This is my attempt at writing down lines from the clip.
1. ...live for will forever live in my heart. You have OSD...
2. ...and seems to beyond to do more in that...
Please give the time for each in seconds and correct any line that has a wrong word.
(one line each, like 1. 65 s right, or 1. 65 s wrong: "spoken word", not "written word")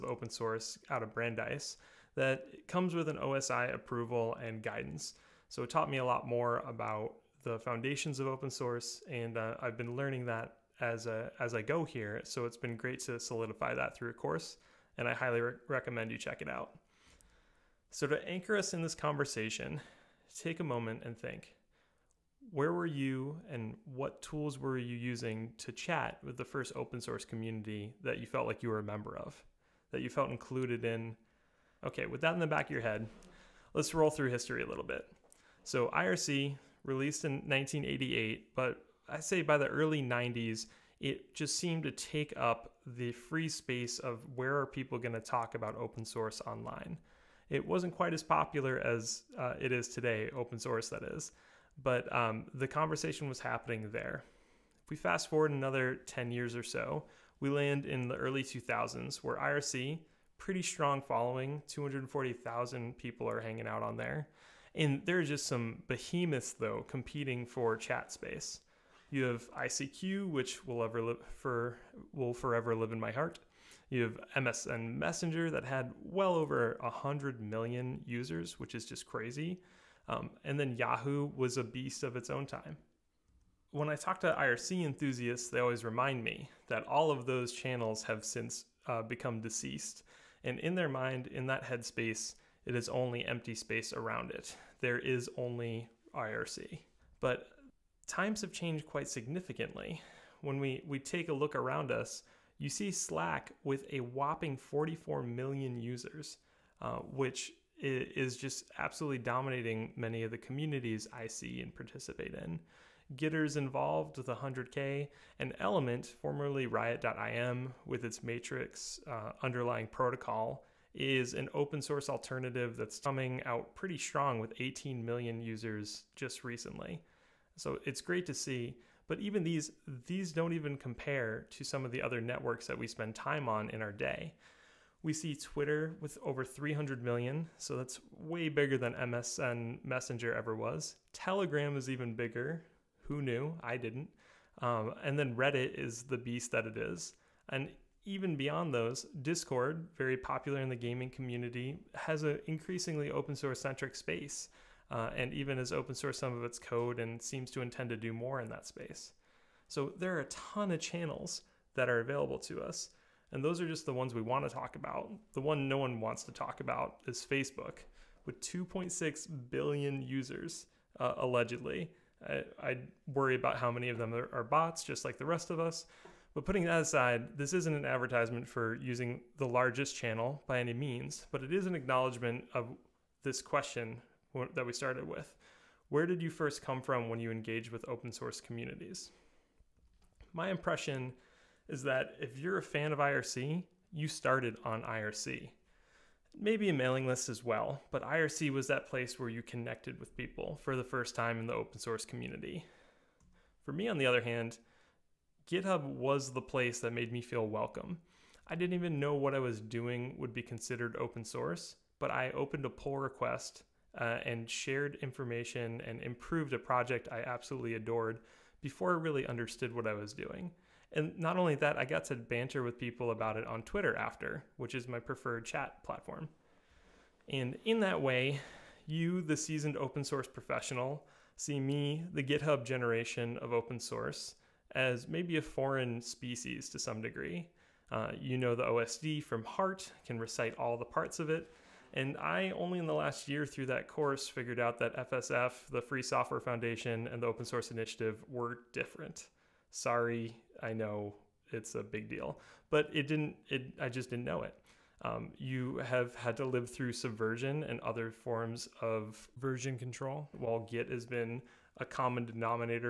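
1. 71 s wrong: "MSN", not "OSD"
2. 156 s wrong: "intend", not "beyond".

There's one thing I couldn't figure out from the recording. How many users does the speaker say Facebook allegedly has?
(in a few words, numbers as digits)
2.6 billion.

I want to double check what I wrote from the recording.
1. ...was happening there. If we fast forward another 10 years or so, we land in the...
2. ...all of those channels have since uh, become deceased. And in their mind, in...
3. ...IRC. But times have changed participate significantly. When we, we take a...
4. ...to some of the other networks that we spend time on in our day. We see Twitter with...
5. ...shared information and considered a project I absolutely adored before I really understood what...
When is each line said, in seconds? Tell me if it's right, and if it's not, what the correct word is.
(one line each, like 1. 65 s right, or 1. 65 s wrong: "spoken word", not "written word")
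1. 53 s right
2. 86 s right
3. 96 s wrong: "quite", not "participate"
4. 131 s right
5. 214 s wrong: "improved", not "considered".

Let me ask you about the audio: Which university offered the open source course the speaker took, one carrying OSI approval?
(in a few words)
Brandeis.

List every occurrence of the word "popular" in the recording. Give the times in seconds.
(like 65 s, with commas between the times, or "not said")
48 s, 150 s.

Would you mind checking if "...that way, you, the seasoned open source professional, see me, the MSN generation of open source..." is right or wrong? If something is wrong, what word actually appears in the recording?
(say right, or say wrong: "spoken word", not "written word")
wrong: "GitHub", not "MSN".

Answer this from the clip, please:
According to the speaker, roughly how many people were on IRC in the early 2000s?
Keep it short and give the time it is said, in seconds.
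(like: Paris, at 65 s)
240,000, at 61 s.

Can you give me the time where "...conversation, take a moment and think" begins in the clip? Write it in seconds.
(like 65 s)
18 s.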